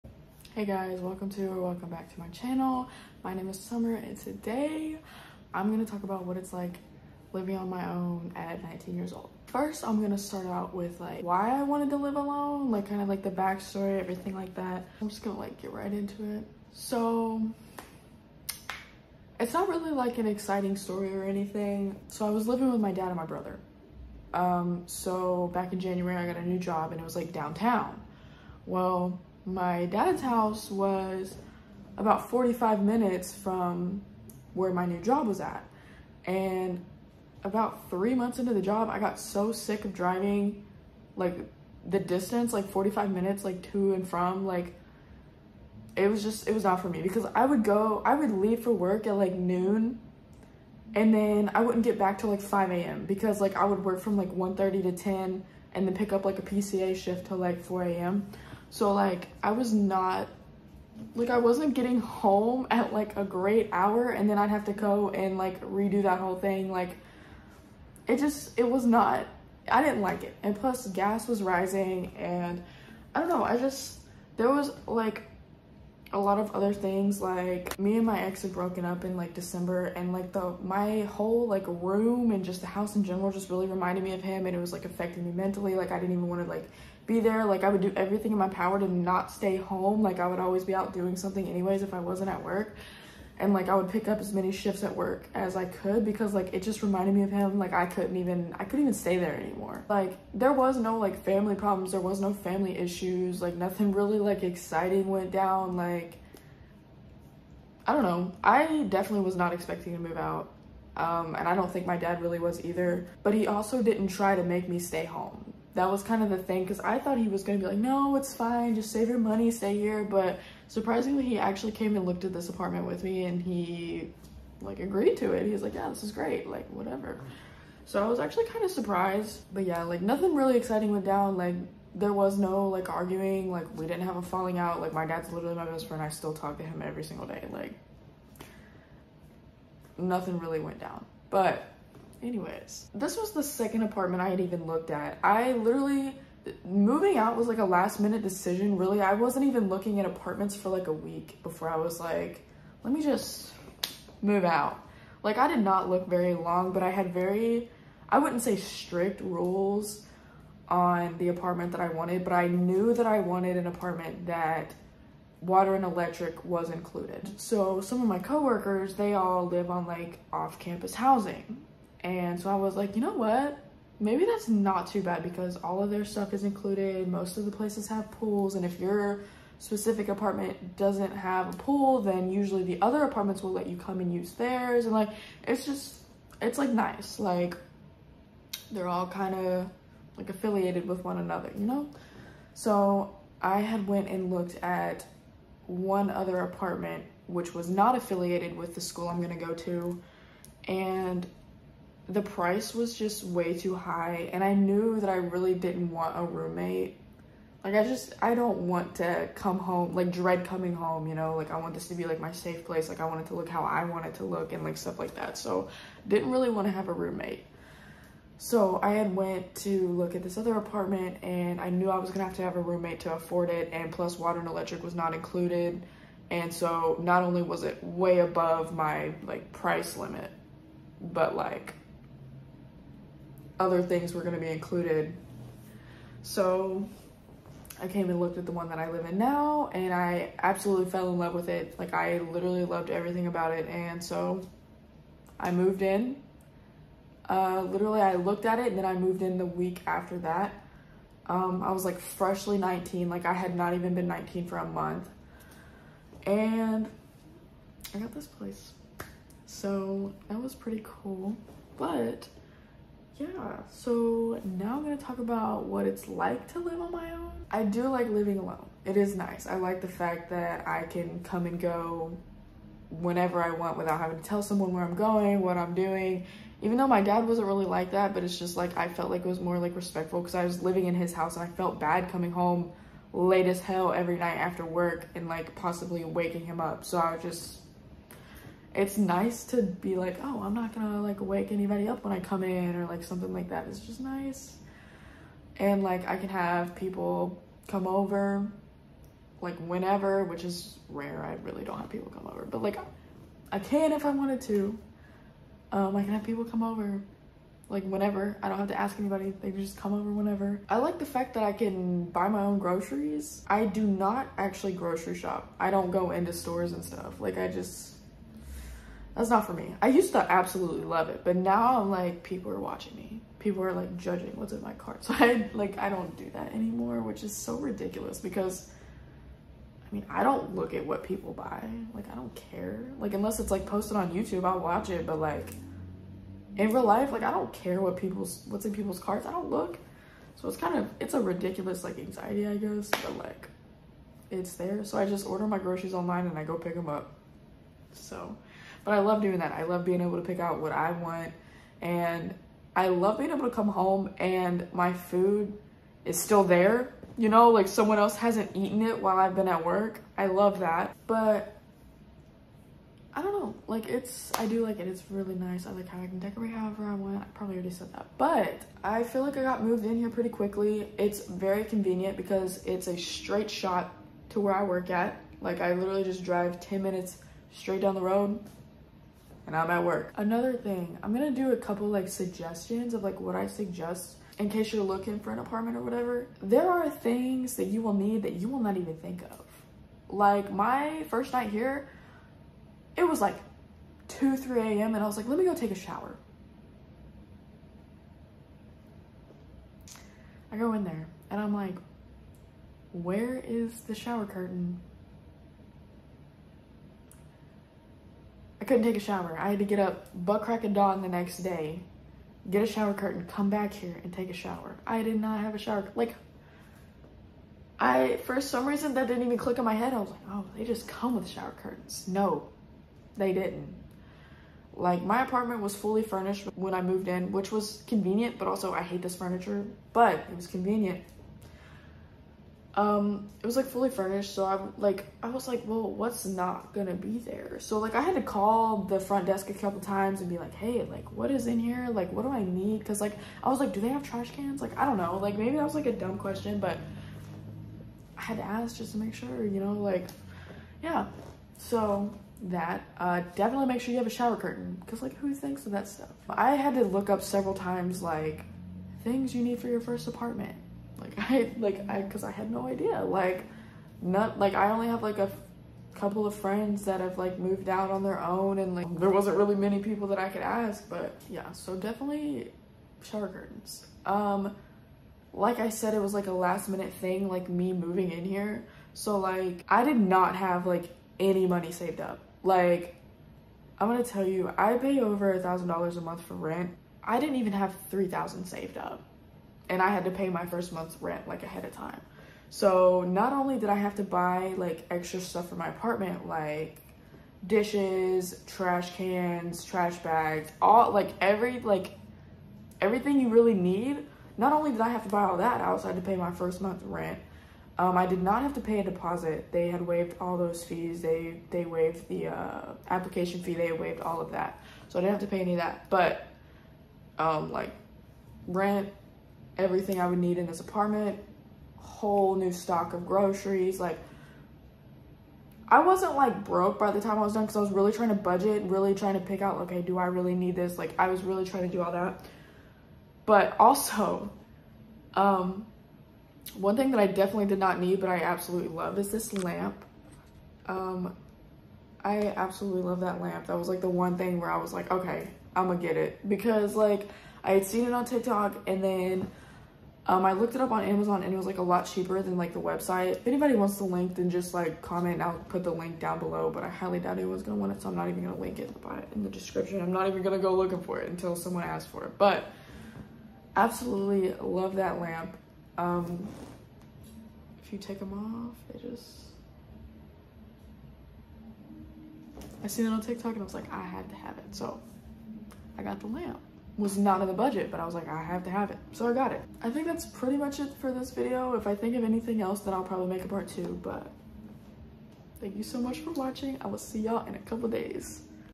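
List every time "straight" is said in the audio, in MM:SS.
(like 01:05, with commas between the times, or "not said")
06:12, 06:17.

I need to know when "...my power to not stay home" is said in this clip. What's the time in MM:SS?
01:28.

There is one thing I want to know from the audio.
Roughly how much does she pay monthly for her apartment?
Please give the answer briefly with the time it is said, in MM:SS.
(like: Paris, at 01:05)
Over $1,000, at 08:04.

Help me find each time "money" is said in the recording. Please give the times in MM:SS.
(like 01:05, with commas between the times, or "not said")
01:59, 08:01.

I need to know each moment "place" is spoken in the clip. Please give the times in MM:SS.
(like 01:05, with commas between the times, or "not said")
02:57, 03:32, 04:18.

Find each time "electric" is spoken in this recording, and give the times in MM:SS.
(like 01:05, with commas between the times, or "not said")
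02:45, 03:44.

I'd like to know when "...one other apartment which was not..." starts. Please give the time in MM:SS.
03:15.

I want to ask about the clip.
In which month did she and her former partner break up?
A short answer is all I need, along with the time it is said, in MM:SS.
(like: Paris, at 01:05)
December, at 01:19.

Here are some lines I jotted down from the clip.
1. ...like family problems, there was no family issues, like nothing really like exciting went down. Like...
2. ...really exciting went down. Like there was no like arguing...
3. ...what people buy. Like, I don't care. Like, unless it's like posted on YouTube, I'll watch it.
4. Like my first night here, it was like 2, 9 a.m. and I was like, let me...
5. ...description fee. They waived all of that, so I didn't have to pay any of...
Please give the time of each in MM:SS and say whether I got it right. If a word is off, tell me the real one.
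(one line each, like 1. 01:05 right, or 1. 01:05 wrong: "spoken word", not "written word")
1. 01:40 right
2. 02:10 right
3. 05:30 right
4. 06:30 wrong: "3", not "9"
5. 08:32 wrong: "application", not "description".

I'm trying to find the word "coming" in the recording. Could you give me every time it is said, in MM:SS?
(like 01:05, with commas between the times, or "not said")
03:30, 04:42.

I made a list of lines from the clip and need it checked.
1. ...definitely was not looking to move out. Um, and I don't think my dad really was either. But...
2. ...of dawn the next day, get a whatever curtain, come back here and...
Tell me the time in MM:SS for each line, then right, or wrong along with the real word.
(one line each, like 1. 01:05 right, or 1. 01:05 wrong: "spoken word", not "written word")
1. 01:48 wrong: "expecting", not "looking"
2. 06:50 wrong: "shower", not "whatever".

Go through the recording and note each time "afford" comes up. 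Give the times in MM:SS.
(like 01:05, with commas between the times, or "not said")
03:43.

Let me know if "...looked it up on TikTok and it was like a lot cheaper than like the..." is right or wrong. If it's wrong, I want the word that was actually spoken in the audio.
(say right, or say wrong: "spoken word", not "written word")
wrong: "Amazon", not "TikTok".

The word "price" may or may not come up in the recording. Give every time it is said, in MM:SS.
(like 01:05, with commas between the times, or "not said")
03:22, 03:49.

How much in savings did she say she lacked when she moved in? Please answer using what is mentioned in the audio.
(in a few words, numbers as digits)
3,000.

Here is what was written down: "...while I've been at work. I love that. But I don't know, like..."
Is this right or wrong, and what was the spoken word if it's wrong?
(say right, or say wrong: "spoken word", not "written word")
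right.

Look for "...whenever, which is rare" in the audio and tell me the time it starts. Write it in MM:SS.
04:59.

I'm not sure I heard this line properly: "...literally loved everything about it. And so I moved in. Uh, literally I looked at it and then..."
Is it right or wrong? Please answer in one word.
right.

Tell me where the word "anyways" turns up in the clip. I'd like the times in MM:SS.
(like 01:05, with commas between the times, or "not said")
01:31, 02:22.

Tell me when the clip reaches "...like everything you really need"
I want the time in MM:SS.
08:21.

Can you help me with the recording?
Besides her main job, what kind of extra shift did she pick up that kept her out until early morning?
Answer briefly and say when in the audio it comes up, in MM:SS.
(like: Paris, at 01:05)
PCA shift, at 00:56.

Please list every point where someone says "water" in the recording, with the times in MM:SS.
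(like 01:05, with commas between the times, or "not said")
02:45, 03:44.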